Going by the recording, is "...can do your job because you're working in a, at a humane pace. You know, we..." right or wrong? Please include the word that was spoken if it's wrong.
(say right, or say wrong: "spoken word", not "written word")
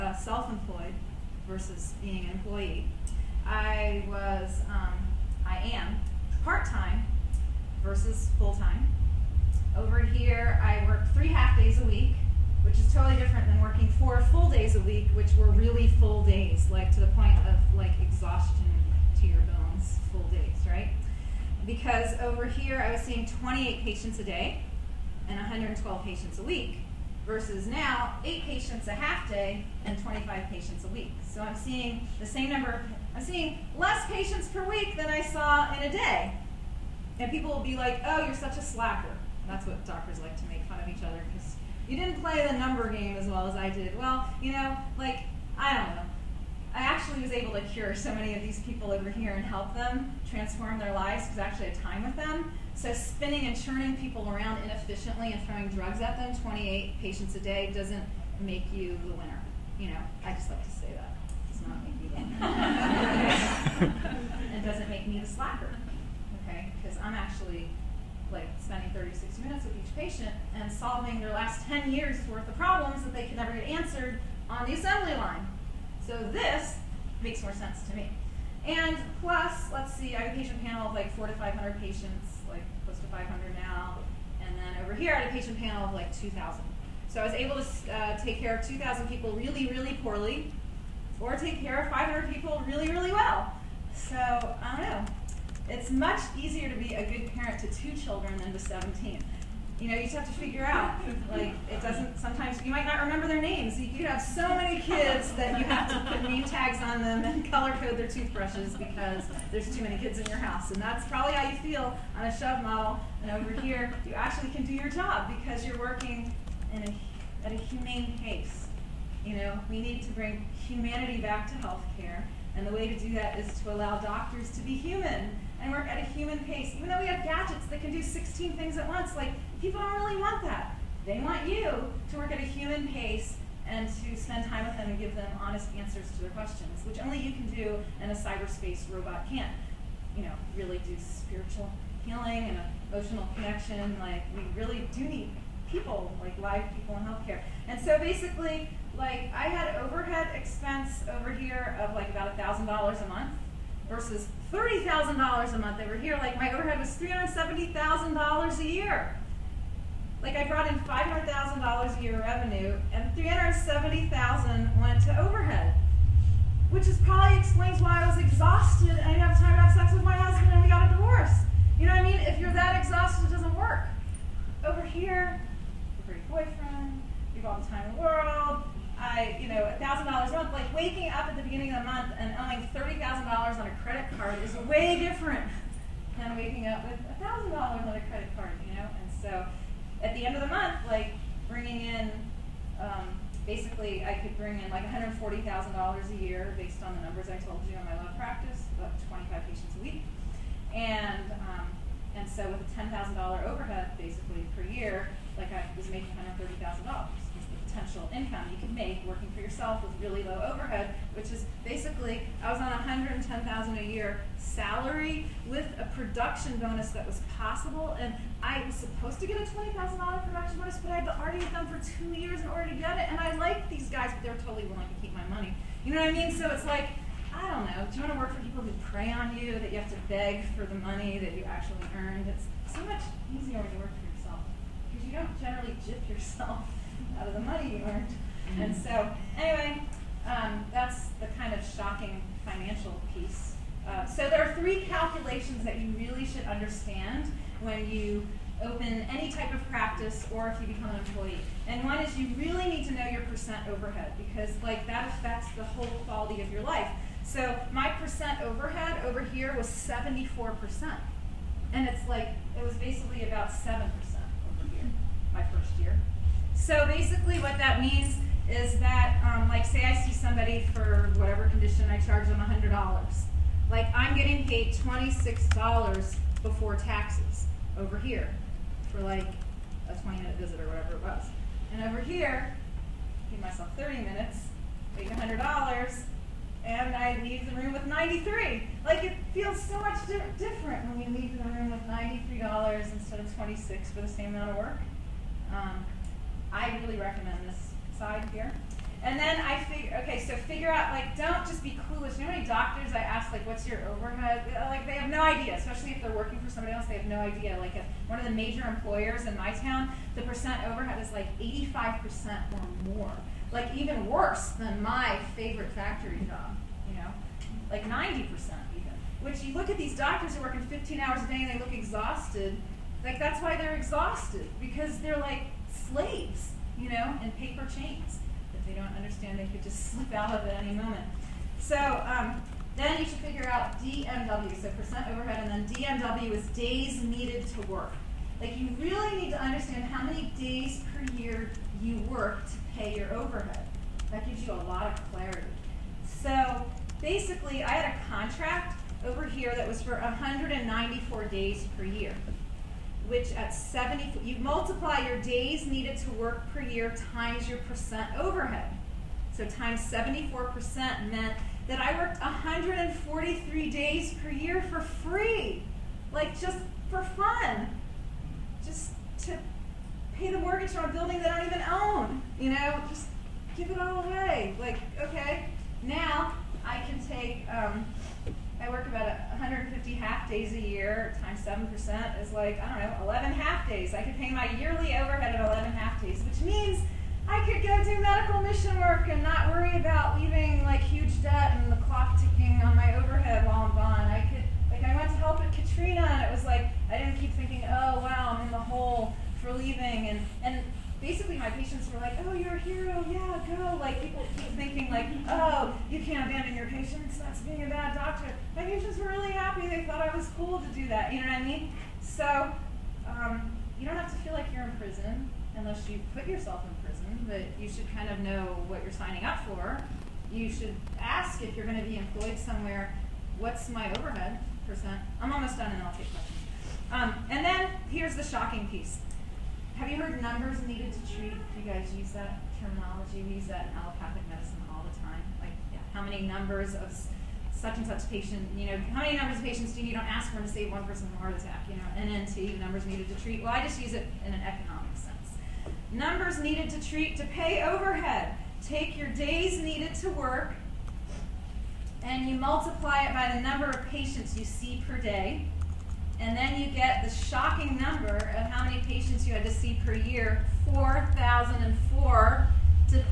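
right.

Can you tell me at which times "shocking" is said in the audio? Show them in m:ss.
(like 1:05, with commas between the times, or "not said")
4:01, 7:08, 7:37.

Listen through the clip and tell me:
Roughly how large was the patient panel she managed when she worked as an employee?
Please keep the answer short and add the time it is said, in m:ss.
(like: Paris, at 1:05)
2,000, at 1:25.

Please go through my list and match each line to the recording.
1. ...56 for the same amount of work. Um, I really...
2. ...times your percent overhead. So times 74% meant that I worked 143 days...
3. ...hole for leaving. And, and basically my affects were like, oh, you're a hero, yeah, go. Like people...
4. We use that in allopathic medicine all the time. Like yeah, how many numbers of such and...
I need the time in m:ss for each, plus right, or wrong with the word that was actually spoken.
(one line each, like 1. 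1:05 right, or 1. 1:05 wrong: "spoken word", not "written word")
1. 4:53 wrong: "26", not "56"
2. 5:57 right
3. 6:38 wrong: "patients", not "affects"
4. 7:13 right.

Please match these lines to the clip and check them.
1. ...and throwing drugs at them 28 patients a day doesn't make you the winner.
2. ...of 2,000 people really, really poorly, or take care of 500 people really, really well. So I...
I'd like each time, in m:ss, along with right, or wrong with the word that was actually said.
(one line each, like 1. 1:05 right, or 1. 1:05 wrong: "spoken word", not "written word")
1. 0:55 right
2. 1:28 right.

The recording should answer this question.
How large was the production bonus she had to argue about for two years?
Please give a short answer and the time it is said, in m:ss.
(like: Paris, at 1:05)
$20,000, at 3:39.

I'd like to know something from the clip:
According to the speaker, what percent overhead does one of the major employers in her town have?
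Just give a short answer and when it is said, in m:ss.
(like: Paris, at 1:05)
85%, at 5:11.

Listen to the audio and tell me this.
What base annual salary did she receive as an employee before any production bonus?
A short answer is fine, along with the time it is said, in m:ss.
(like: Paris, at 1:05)
$110,000, at 3:32.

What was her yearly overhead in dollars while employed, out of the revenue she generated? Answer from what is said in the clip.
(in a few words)
$370,000.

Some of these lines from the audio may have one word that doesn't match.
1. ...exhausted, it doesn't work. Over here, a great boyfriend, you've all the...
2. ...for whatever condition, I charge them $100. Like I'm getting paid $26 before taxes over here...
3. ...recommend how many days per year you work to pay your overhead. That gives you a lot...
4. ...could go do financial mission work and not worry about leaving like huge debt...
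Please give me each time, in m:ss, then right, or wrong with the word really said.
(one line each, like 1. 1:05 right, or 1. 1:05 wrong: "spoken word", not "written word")
1. 2:52 right
2. 4:30 right
3. 5:39 wrong: "understand", not "recommend"
4. 6:27 wrong: "medical", not "financial".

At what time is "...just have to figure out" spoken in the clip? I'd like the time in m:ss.
1:40.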